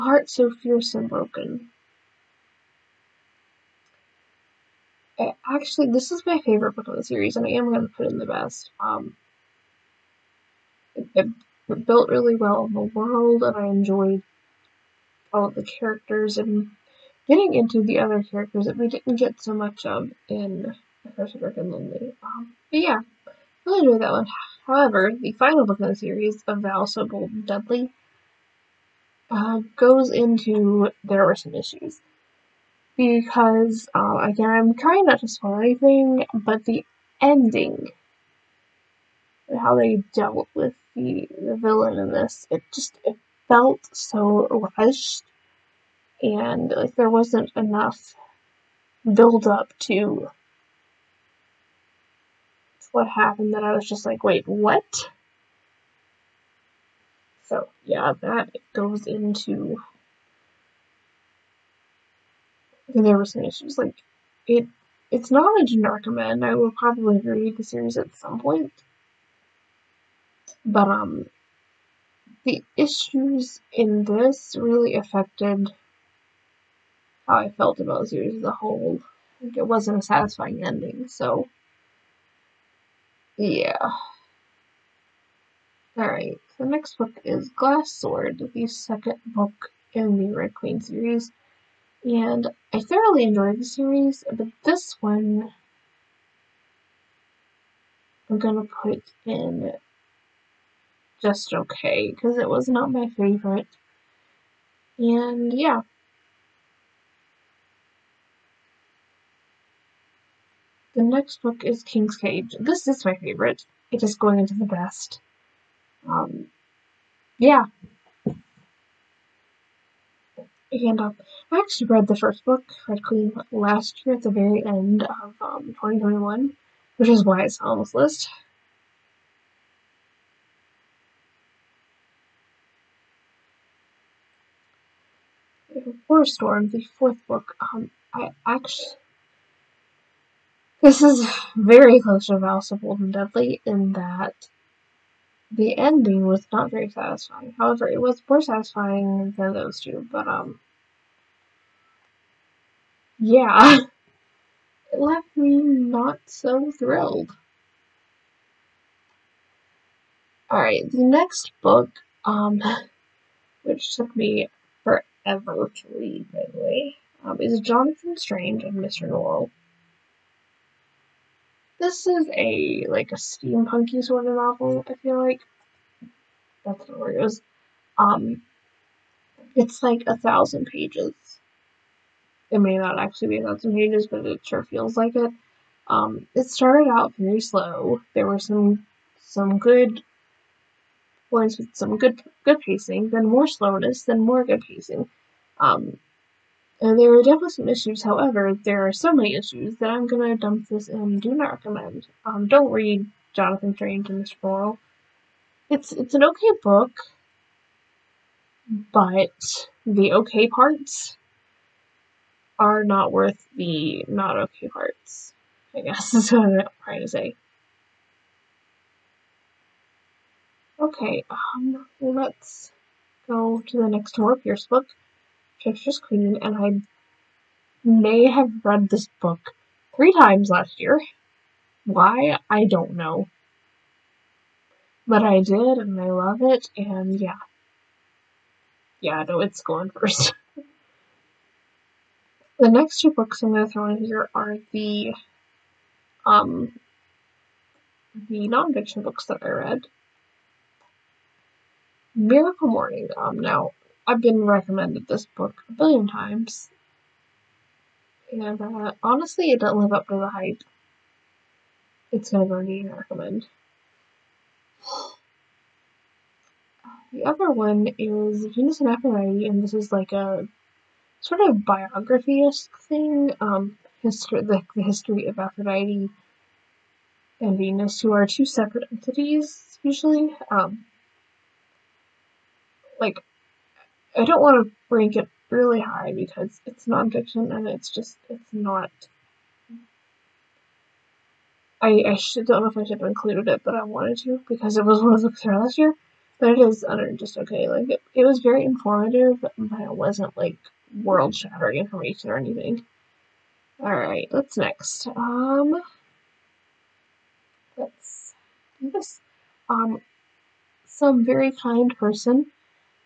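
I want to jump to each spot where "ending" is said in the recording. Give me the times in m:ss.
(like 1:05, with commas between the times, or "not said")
0:37, 1:20, 2:25.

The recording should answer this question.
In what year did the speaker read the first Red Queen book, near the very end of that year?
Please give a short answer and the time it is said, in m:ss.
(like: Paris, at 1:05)
2021, at 2:05.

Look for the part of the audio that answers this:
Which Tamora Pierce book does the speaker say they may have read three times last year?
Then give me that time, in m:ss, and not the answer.
3:45.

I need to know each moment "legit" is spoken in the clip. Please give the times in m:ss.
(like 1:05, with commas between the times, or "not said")
not said.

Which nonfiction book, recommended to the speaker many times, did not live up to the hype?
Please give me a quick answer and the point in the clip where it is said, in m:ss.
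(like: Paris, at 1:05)
Miracle Morning, at 4:12.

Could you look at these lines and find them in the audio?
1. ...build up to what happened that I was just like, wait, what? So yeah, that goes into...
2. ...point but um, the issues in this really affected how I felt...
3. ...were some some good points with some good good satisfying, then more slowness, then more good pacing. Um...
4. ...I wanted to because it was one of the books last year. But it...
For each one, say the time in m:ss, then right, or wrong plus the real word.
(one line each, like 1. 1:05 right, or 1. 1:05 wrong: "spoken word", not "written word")
1. 0:49 right
2. 1:08 right
3. 3:08 wrong: "pacing", not "satisfying"
4. 4:53 right.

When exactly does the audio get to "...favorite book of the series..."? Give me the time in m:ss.
0:06.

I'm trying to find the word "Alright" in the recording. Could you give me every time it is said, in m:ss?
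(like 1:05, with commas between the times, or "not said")
1:25, 2:40, 5:03.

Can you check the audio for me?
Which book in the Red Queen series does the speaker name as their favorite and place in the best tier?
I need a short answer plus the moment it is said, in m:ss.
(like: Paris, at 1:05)
King's Cage, at 1:51.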